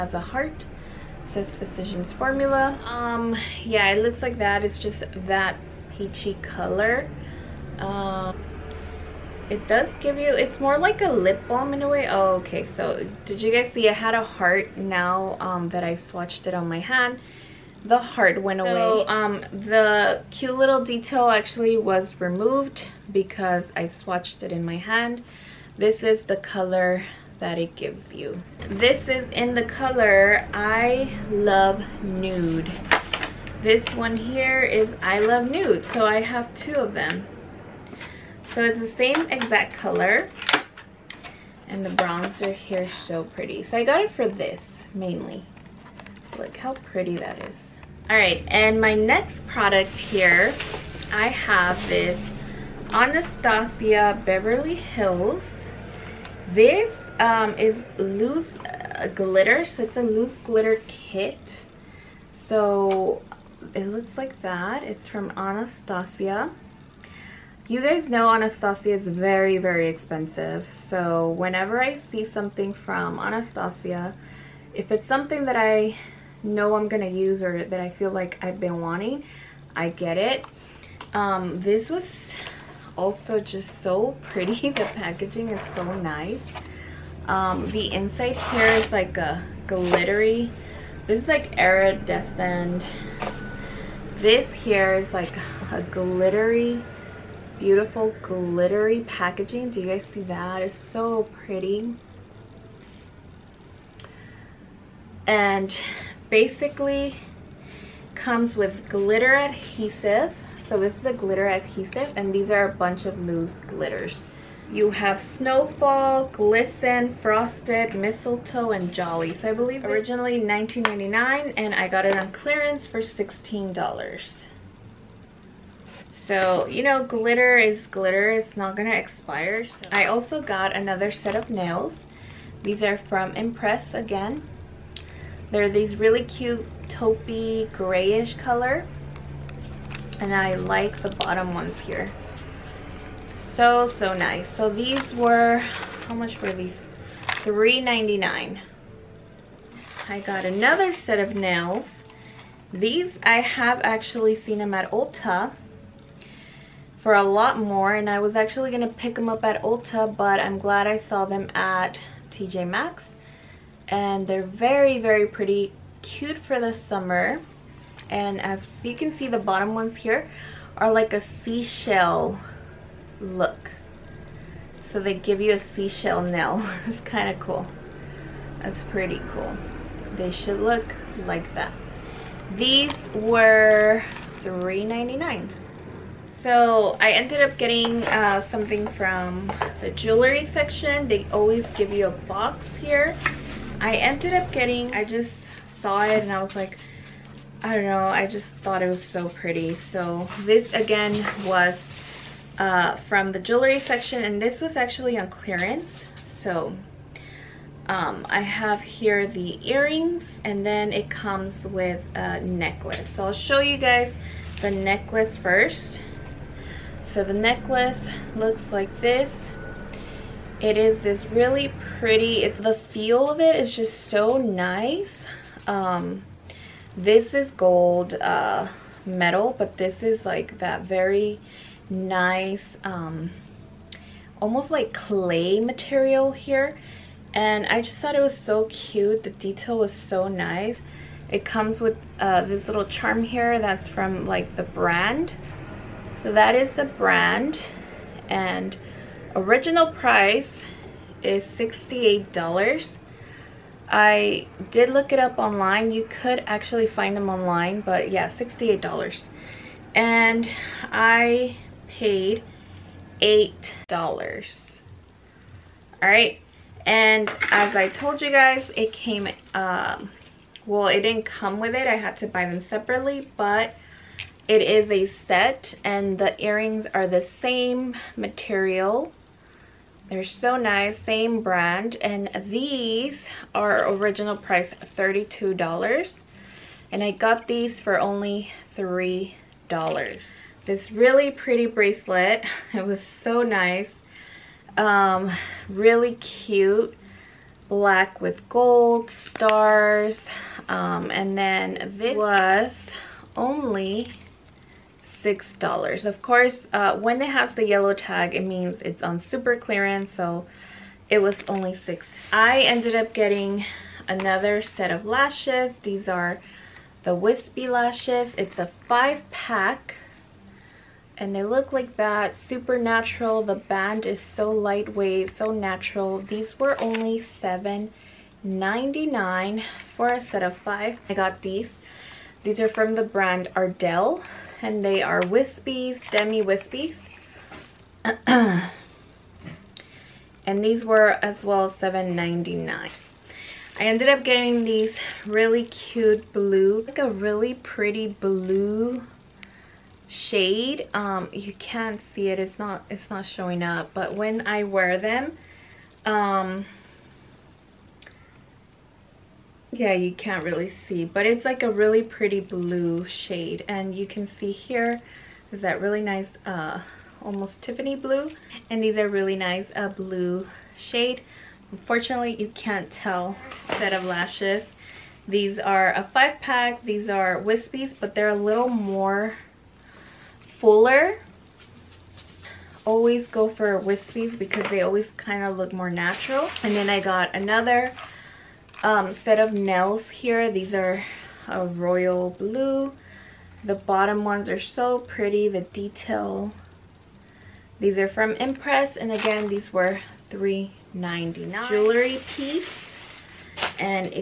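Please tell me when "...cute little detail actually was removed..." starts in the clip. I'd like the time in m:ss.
0:20.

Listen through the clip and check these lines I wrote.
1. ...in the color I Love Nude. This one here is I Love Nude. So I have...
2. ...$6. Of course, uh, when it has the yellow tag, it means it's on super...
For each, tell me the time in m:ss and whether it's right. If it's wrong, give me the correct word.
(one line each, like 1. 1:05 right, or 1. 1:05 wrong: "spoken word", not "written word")
1. 0:29 right
2. 5:05 right.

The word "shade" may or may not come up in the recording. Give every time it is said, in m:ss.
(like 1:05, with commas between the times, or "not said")
5:50, 6:03, 6:10.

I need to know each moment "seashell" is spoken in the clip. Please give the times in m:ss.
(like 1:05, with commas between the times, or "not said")
2:51, 2:55.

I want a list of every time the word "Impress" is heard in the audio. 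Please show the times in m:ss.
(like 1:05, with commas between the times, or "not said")
2:13, 6:38.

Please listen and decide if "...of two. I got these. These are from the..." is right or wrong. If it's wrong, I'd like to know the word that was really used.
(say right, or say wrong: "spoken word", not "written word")
wrong: "five", not "two".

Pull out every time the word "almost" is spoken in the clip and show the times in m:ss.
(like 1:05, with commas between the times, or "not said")
3:54, 6:07.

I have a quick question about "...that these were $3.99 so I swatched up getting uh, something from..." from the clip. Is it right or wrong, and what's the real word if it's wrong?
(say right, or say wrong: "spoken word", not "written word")
wrong: "ended", not "swatched".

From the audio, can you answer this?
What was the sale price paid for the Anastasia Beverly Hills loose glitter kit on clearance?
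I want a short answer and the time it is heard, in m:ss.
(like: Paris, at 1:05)
$16, at 2:02.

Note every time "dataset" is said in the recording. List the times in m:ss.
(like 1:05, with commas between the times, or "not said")
not said.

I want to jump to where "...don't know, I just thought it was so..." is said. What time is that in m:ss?
3:17.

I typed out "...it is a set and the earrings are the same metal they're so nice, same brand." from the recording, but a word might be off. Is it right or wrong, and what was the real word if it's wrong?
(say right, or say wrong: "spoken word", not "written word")
wrong: "material", not "metal".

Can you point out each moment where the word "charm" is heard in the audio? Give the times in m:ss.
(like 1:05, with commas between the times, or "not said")
4:02.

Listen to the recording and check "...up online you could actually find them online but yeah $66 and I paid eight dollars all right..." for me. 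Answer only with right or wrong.
wrong.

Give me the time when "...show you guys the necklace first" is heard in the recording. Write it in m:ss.
3:33.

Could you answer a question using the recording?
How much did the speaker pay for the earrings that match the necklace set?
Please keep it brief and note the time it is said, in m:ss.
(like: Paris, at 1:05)
$3, at 4:48.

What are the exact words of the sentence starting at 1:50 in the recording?
So this is a glitter adhesive and these are a bunch of loose glitters.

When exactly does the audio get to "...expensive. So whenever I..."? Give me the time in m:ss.
1:09.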